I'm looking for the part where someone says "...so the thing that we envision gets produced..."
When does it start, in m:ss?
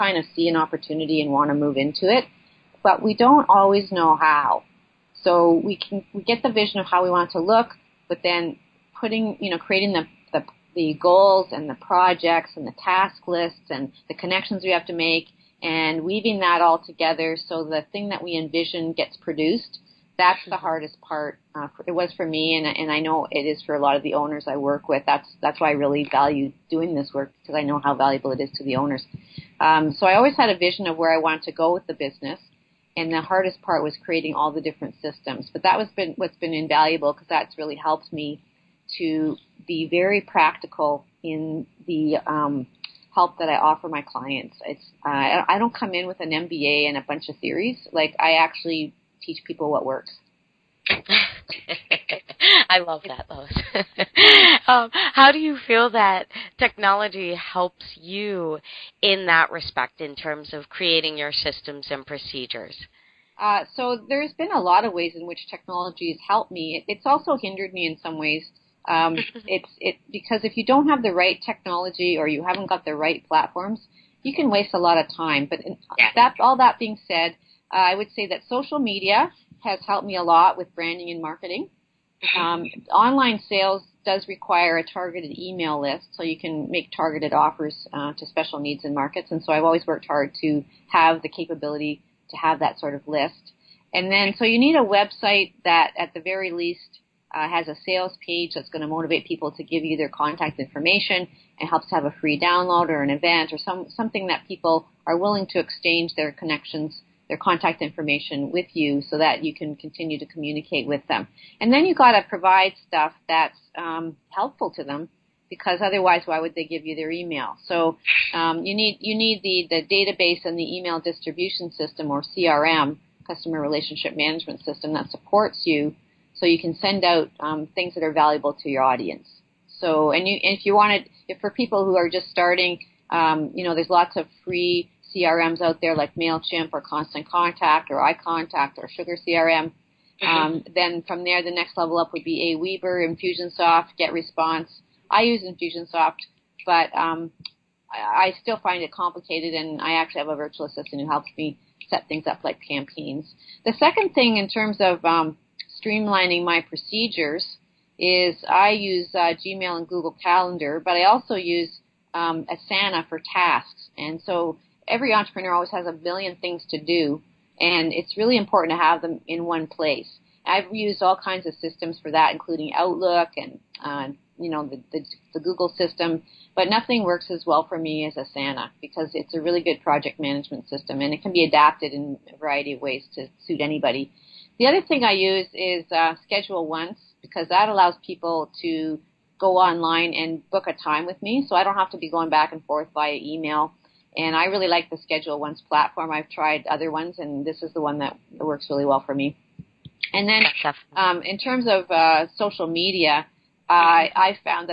0:17.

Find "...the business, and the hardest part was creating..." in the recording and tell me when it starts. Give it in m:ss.
0:31.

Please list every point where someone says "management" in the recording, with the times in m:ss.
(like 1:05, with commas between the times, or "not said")
2:04, 3:00.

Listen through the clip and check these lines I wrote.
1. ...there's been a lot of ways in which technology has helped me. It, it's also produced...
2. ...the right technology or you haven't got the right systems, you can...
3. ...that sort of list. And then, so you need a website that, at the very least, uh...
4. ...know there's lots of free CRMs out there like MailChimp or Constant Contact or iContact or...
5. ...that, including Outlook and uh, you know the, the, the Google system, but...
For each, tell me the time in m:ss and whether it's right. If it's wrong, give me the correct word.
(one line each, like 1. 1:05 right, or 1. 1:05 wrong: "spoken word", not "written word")
1. 1:04 wrong: "hindered", not "produced"
2. 1:11 wrong: "platforms", not "systems"
3. 1:32 right
4. 2:13 right
5. 2:52 right.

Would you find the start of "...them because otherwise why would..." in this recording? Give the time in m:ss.
1:54.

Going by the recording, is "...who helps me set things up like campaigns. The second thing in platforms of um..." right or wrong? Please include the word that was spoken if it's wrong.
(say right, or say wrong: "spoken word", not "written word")
wrong: "terms", not "platforms".